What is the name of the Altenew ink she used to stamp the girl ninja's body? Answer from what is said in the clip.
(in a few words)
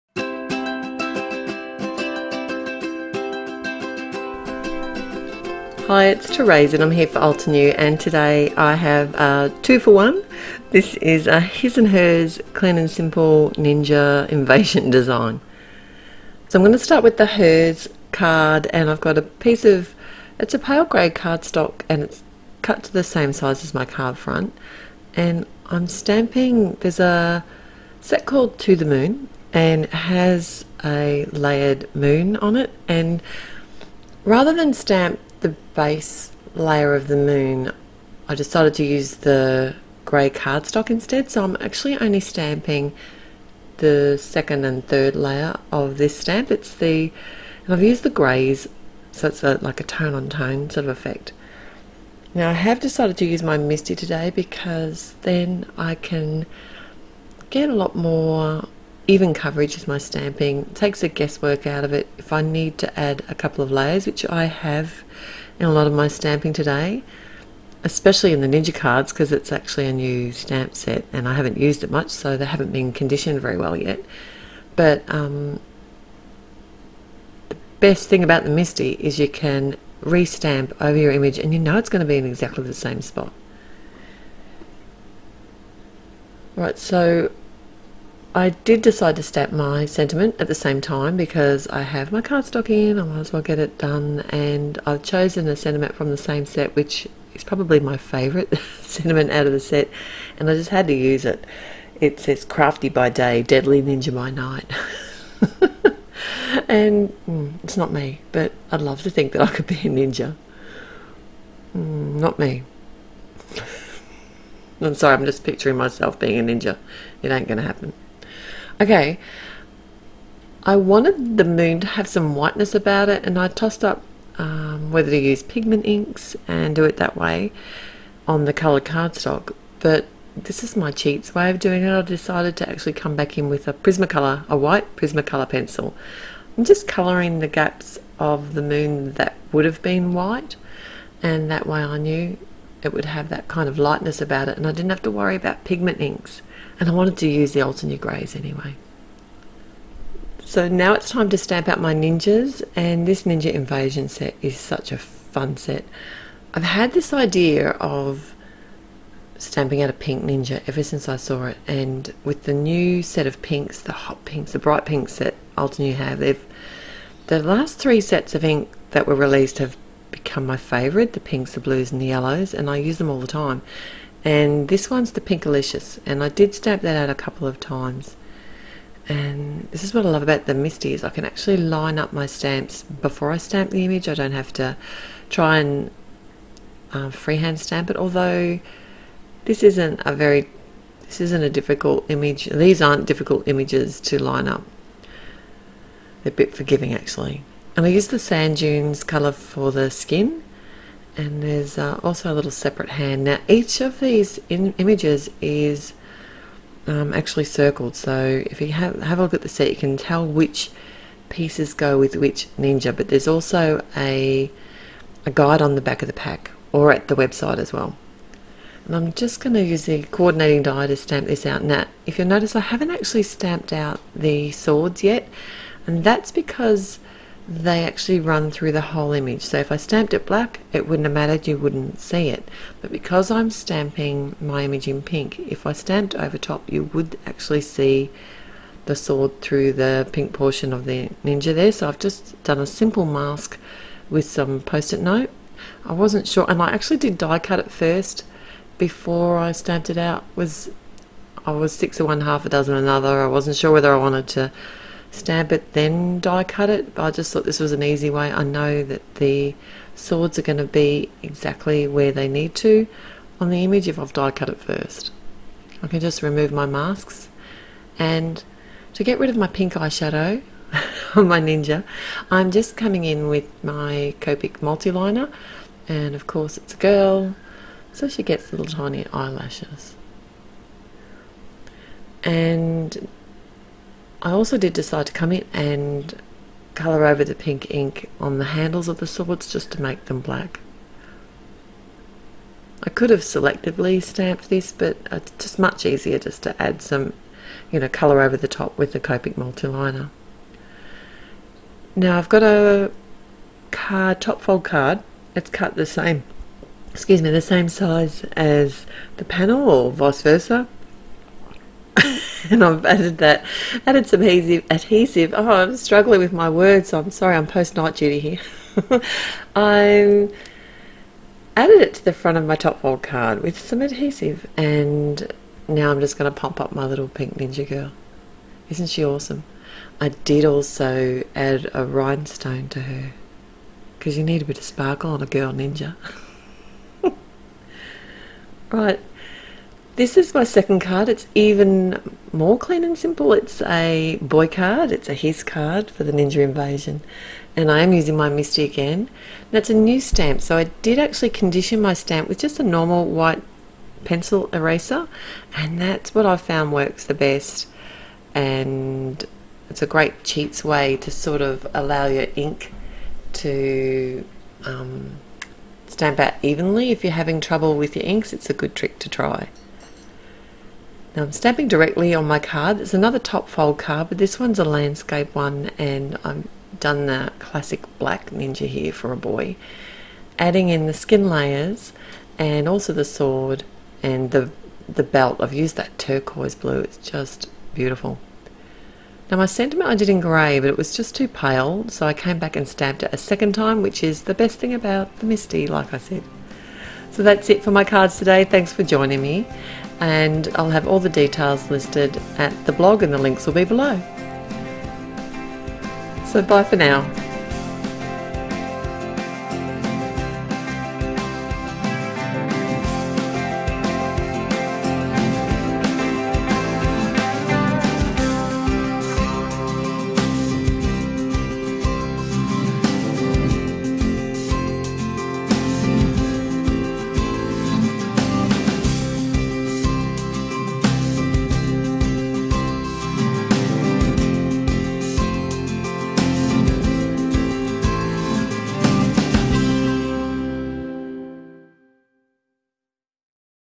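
Pinkalicious.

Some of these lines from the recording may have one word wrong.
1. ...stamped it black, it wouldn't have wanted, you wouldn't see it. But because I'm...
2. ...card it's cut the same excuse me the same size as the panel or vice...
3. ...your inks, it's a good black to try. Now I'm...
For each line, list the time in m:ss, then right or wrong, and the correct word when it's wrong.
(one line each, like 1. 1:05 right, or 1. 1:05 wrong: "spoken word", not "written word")
1. 3:49 wrong: "mattered", not "wanted"
2. 5:04 right
3. 6:07 wrong: "trick", not "black".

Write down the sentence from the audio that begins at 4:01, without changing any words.
So I've just done a simple mask with some post-it note.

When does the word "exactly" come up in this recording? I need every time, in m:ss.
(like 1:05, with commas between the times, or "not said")
1:22, 4:21.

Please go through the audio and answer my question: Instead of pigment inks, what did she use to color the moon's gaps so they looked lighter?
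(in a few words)
white Prismacolor pencil.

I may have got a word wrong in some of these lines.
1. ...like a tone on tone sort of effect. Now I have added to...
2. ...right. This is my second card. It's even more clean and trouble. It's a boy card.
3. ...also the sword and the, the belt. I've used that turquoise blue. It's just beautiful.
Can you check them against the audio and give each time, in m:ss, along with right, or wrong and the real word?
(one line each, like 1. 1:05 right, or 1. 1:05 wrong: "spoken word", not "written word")
1. 0:49 wrong: "decided", not "added"
2. 5:38 wrong: "simple", not "trouble"
3. 6:22 right.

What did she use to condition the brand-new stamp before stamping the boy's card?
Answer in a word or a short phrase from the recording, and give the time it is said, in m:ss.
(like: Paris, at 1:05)
white pencil eraser, at 5:53.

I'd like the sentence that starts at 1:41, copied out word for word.
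It says crafty by day, deadly ninja by night.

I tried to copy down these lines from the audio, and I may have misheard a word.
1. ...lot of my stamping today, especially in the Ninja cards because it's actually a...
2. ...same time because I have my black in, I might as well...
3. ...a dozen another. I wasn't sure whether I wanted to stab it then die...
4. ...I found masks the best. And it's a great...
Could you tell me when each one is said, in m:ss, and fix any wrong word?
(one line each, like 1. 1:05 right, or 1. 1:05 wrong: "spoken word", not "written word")
1. 1:05 right
2. 1:30 wrong: "cardstock", not "black"
3. 4:12 right
4. 5:56 wrong: "works", not "masks".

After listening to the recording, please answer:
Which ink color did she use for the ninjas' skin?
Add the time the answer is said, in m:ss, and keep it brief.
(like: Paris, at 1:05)
Sand Dunes, at 3:18.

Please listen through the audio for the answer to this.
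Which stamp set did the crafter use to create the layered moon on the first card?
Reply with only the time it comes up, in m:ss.
0:28.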